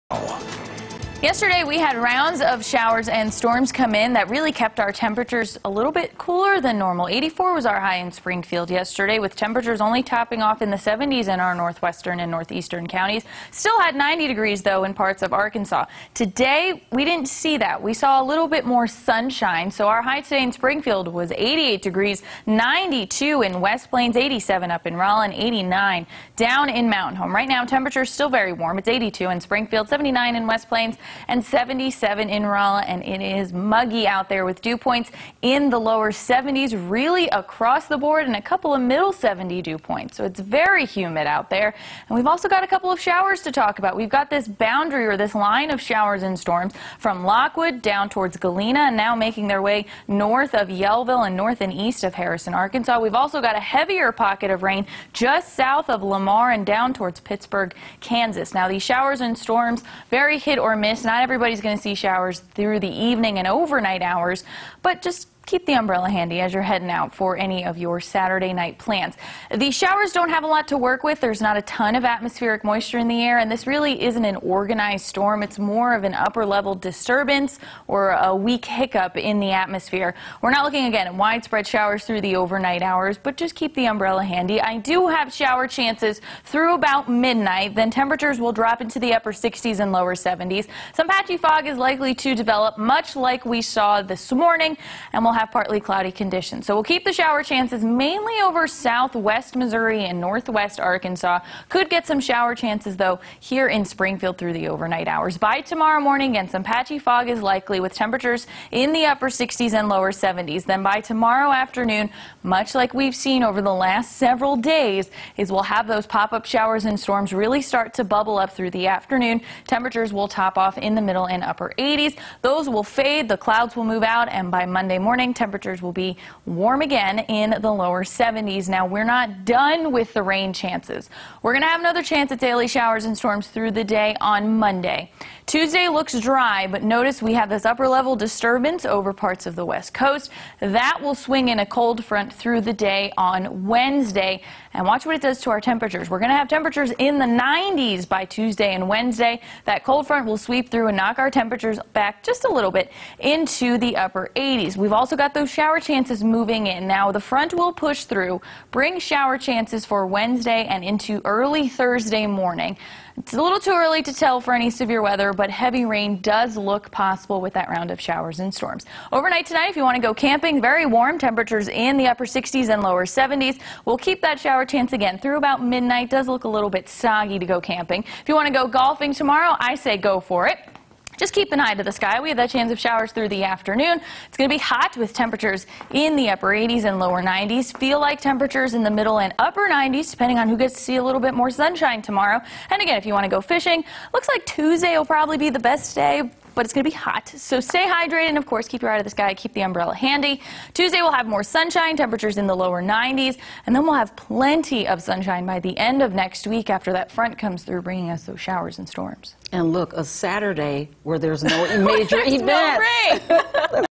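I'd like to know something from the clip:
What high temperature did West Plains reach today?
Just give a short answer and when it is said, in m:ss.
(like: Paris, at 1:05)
92, at 0:22.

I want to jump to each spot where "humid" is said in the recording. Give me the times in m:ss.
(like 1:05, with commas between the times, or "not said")
0:40.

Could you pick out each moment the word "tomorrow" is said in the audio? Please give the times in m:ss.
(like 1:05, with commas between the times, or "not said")
1:45, 1:50, 2:59, 3:12.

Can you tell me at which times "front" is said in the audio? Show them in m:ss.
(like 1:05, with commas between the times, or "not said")
2:22, 2:30, 2:37, 3:27.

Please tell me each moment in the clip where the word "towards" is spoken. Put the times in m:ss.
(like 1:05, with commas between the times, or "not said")
0:48, 0:56.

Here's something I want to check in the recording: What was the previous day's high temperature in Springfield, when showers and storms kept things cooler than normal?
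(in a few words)
84.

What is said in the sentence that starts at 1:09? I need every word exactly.
The showers don't have a lot to work with.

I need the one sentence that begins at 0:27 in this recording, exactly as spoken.
Right now, temperatures still very warm.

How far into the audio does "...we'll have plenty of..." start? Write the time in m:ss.
3:23.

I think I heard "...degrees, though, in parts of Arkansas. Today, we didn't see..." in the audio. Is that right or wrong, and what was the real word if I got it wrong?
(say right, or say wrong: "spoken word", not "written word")
right.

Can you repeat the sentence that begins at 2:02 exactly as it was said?
Those will fade, the clouds will move out, and by Monday morning, morning.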